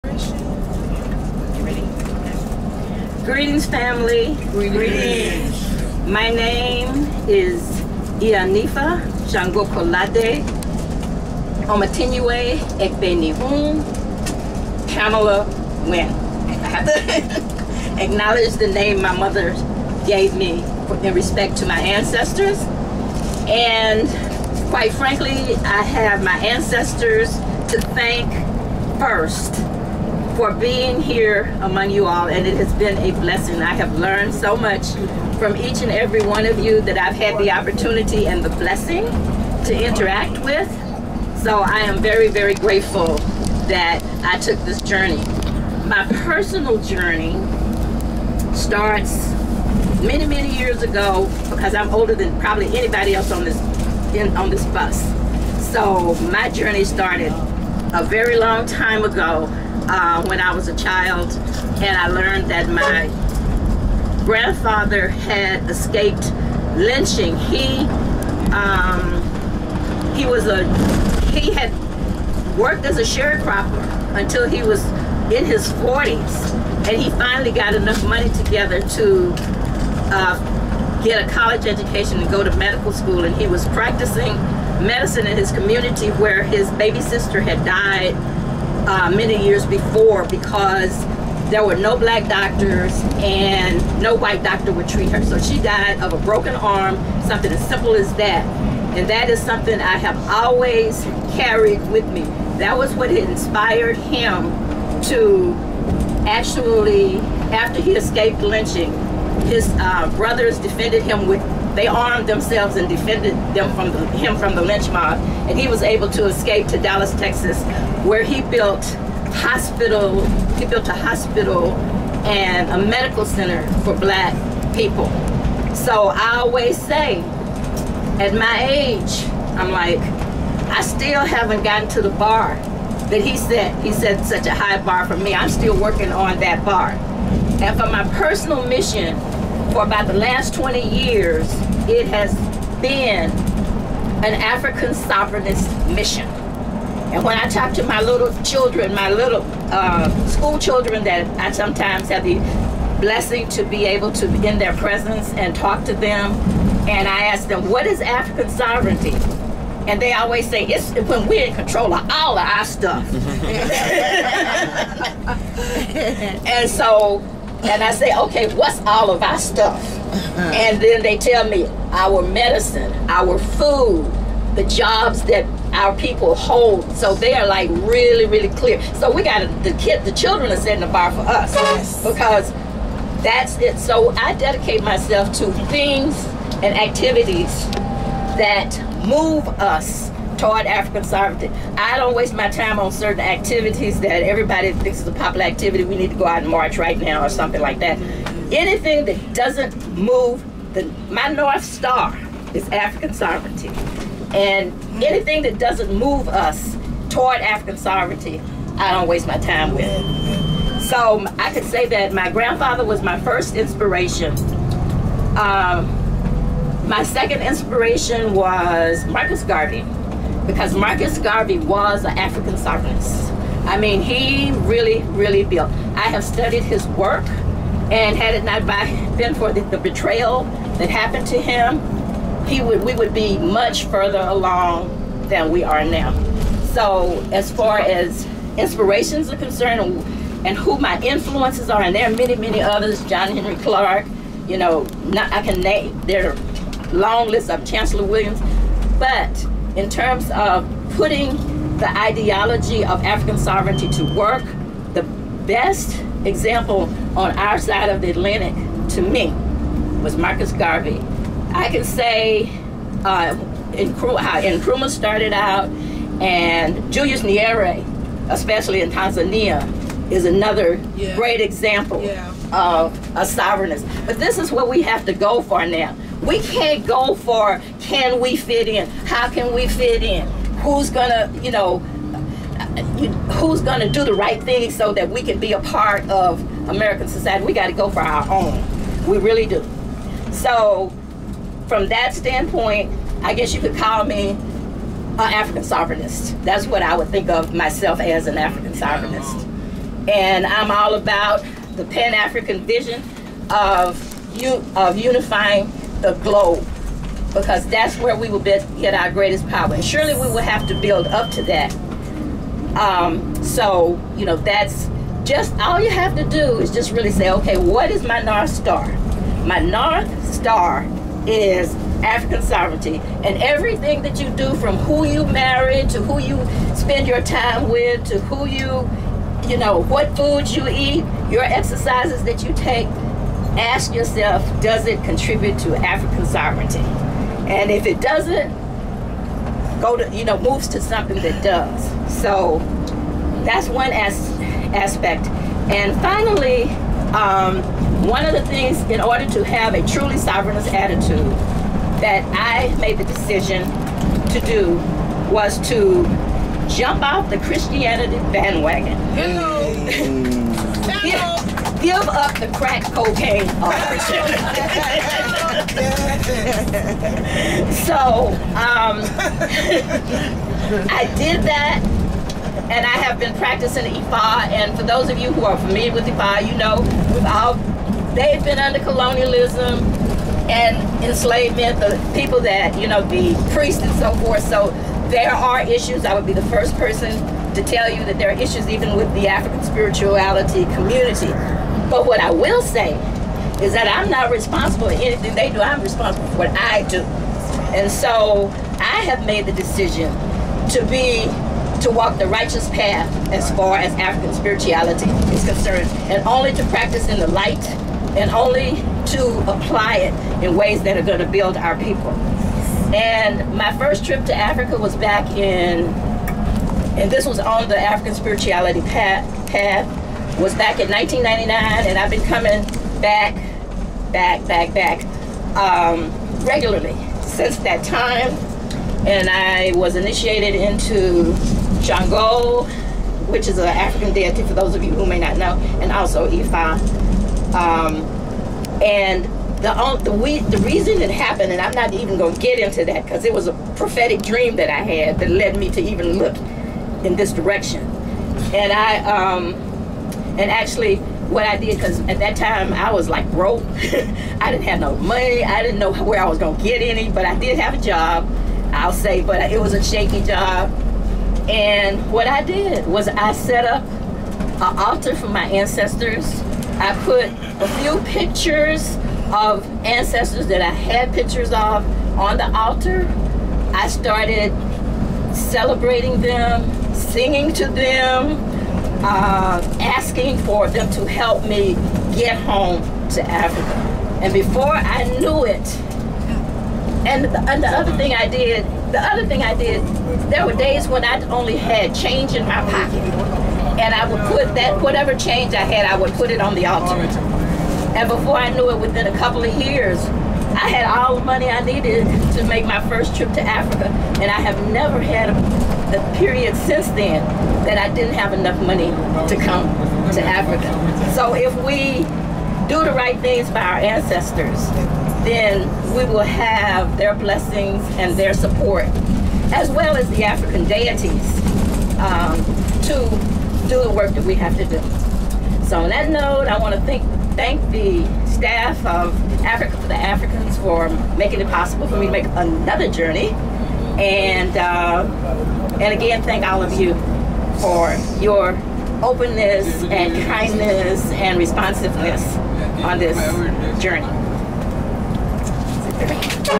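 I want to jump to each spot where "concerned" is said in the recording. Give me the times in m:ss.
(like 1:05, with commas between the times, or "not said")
3:59, 6:45.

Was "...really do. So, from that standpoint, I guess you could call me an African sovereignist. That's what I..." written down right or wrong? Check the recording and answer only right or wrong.
right.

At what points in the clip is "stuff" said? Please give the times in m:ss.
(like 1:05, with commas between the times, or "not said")
2:42, 2:49.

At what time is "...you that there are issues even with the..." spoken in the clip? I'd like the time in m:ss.
6:27.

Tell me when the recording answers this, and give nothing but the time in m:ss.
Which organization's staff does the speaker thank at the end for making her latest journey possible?
8:49.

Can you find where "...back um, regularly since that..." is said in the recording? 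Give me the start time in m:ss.
7:04.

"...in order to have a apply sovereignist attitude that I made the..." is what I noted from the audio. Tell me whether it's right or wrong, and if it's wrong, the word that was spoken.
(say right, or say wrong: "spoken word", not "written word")
wrong: "truly", not "apply".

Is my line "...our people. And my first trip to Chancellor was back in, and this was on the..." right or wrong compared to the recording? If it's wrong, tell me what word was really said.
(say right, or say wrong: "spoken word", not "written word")
wrong: "Africa", not "Chancellor".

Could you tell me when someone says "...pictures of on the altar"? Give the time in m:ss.
7:51.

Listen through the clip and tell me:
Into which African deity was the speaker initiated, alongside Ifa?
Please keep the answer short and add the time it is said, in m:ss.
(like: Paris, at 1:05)
Shango, at 7:11.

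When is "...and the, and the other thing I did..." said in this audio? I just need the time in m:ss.
8:07.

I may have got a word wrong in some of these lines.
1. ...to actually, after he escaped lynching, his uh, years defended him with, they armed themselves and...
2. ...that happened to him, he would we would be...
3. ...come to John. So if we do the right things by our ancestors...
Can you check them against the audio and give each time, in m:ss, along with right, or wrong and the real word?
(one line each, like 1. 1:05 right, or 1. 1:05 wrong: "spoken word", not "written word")
1. 1:45 wrong: "brothers", not "years"
2. 3:50 right
3. 8:29 wrong: "Africa", not "John".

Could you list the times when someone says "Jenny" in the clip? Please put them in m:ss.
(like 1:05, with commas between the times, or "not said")
not said.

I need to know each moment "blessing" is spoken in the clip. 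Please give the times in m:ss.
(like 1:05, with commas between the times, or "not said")
0:33, 0:38, 2:33, 8:37.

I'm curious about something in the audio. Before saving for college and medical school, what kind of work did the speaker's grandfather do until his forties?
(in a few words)
Sharecropper.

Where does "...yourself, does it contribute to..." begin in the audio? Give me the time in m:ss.
5:33.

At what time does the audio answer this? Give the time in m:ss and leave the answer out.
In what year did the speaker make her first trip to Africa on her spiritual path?
7:00.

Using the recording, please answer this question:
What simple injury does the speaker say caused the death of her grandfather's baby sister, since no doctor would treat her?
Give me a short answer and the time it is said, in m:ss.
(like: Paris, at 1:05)
A broken arm, at 1:36.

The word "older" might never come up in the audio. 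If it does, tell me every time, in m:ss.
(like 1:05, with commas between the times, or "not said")
0:51.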